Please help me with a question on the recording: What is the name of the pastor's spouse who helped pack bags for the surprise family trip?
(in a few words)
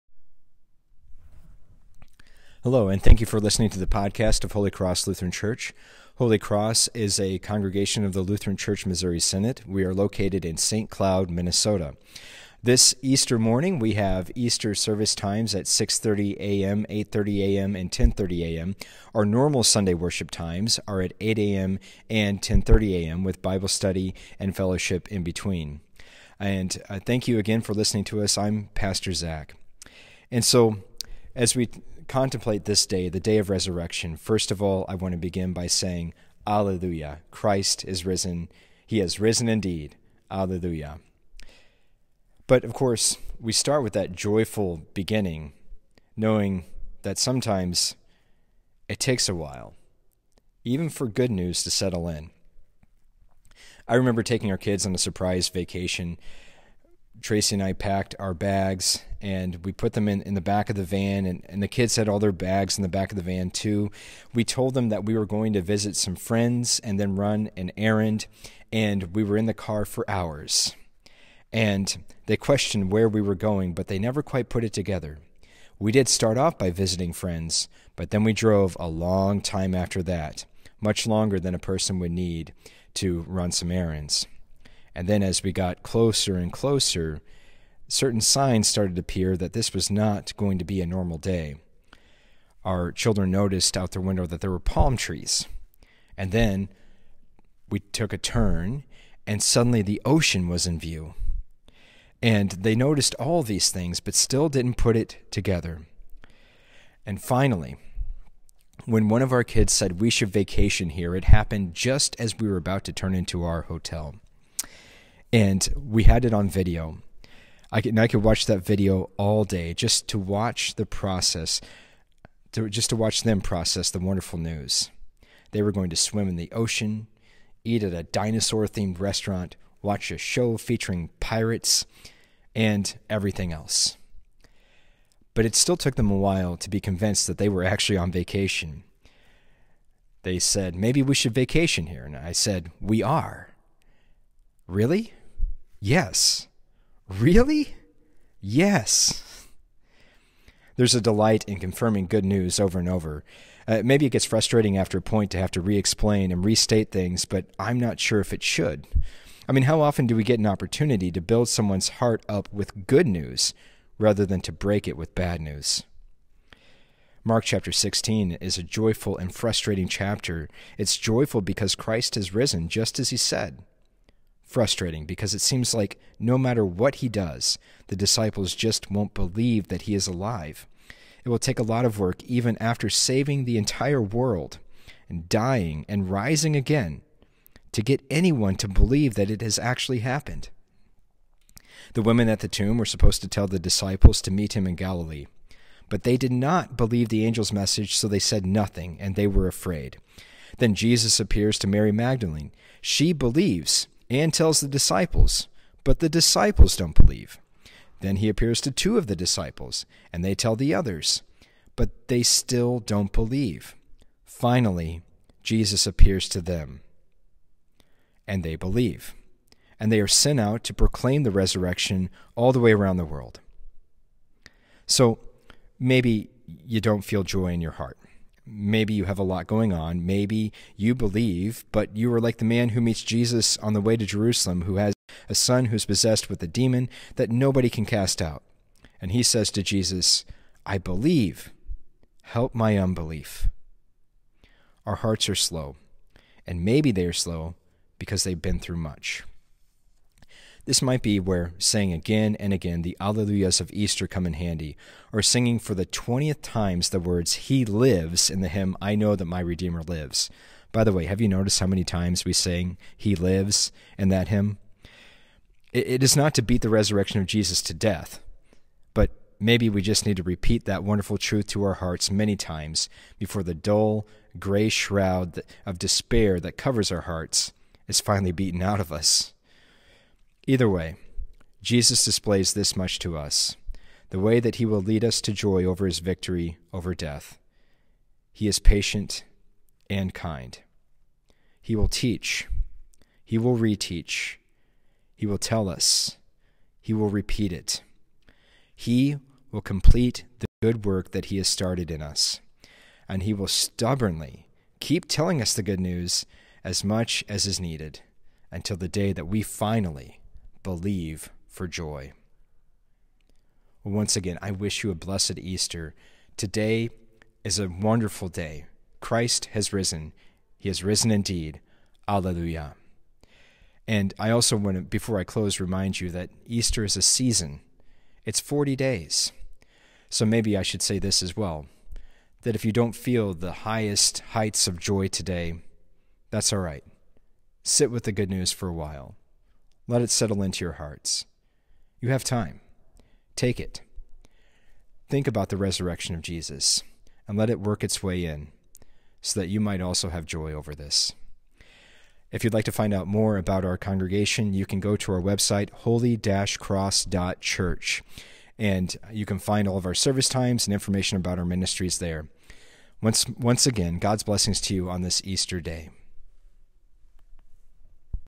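Tracy.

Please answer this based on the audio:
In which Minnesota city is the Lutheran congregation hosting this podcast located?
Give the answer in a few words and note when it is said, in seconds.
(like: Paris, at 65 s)
St. Cloud, at 10 s.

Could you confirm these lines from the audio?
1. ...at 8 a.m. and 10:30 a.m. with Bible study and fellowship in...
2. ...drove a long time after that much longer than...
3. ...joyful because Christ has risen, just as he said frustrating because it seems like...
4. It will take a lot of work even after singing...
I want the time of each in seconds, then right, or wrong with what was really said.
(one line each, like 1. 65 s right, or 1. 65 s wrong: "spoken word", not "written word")
1. 21 s right
2. 78 s right
3. 170 s right
4. 181 s wrong: "saving", not "singing".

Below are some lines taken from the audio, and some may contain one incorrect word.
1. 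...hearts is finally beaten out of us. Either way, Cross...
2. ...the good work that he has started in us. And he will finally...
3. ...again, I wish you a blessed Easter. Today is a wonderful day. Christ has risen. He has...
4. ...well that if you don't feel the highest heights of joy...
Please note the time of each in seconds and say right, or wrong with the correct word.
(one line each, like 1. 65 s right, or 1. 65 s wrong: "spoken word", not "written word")
1. 277 s wrong: "Jesus", not "Cross"
2. 300 s wrong: "stubbornly", not "finally"
3. 314 s right
4. 331 s right.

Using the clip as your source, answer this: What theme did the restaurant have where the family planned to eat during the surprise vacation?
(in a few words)
Dinosaur.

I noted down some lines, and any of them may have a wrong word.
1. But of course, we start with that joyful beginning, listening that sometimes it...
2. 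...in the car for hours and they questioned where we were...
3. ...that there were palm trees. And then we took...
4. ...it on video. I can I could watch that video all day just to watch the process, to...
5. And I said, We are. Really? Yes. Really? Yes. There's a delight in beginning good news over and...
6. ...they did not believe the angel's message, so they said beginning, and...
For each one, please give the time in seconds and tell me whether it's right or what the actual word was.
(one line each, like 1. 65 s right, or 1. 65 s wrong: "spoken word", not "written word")
1. 42 s wrong: "knowing", not "listening"
2. 69 s right
3. 94 s right
4. 116 s right
5. 142 s wrong: "confirming", not "beginning"
6. 196 s wrong: "nothing", not "beginning".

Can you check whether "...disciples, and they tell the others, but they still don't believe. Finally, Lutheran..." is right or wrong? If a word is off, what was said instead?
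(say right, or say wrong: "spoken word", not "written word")
wrong: "Jesus", not "Lutheran".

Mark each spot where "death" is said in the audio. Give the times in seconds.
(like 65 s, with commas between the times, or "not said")
267 s, 286 s.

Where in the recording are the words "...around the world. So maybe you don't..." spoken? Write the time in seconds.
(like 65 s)
222 s.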